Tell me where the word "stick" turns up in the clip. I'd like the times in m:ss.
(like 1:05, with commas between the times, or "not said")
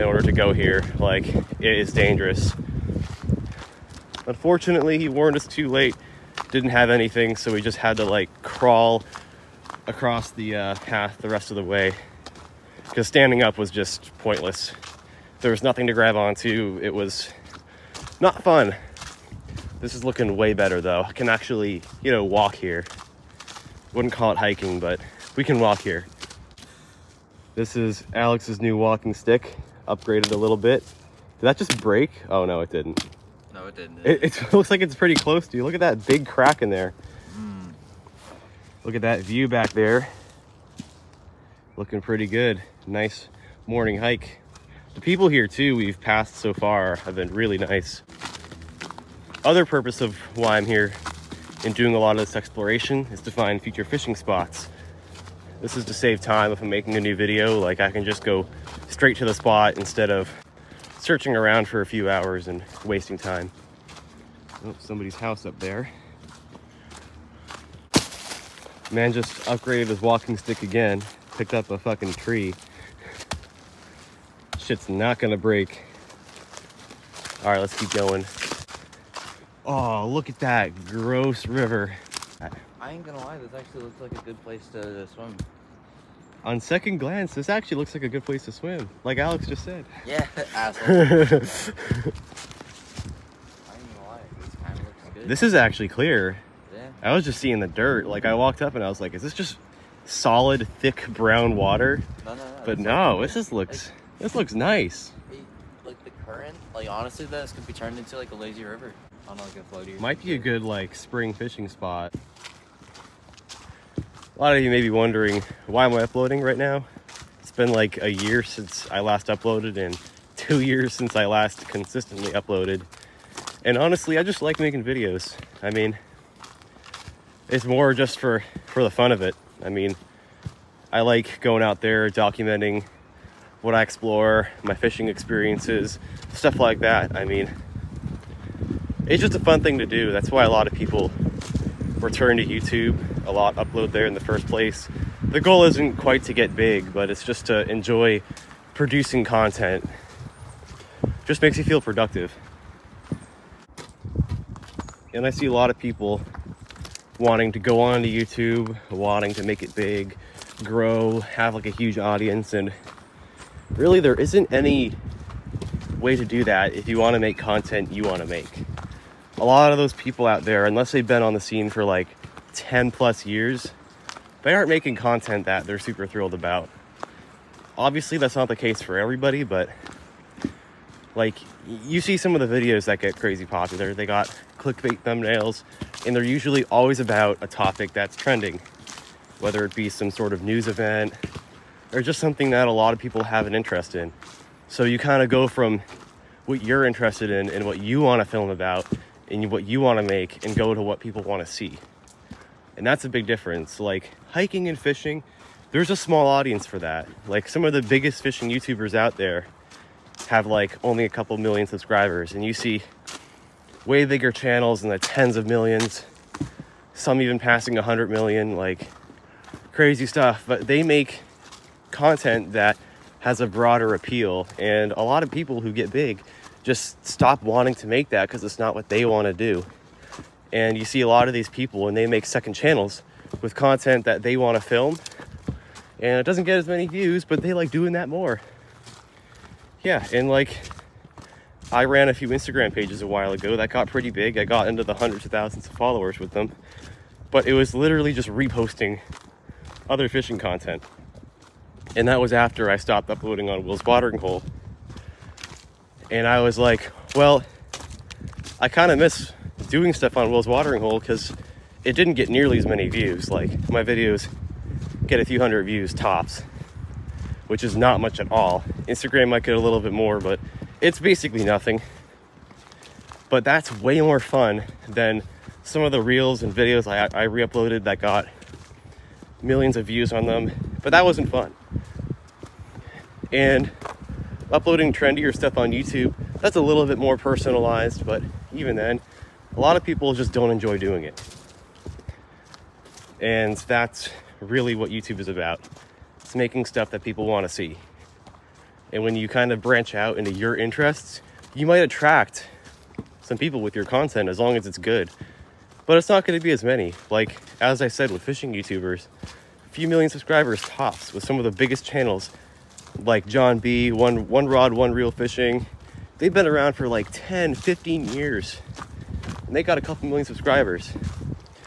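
0:29, 1:10.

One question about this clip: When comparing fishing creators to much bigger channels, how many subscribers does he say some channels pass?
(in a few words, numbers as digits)
100 million.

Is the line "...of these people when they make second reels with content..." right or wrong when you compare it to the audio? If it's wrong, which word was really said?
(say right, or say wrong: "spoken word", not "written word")
wrong: "channels", not "reels".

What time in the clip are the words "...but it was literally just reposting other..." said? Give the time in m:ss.
4:07.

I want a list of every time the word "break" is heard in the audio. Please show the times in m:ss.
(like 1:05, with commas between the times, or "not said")
0:31, 1:15.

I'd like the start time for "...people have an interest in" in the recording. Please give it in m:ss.
3:12.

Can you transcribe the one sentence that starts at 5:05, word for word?
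But it's not going to be as many.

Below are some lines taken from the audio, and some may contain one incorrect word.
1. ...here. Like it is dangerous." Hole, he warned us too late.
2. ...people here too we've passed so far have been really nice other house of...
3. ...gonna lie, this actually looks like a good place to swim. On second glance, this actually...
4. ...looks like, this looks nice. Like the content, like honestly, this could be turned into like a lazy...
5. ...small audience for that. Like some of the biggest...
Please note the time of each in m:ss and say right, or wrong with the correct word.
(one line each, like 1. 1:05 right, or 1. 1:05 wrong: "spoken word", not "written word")
1. 0:00 wrong: "Unfortunately", not "Hole"
2. 0:45 wrong: "purpose", not "house"
3. 1:23 right
4. 1:43 wrong: "current", not "content"
5. 3:25 right.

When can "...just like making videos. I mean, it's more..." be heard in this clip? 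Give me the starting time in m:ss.
2:04.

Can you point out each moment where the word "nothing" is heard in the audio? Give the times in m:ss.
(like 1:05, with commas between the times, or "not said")
0:15, 4:31.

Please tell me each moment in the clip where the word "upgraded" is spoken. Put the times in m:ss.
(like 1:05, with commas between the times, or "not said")
0:29, 1:09.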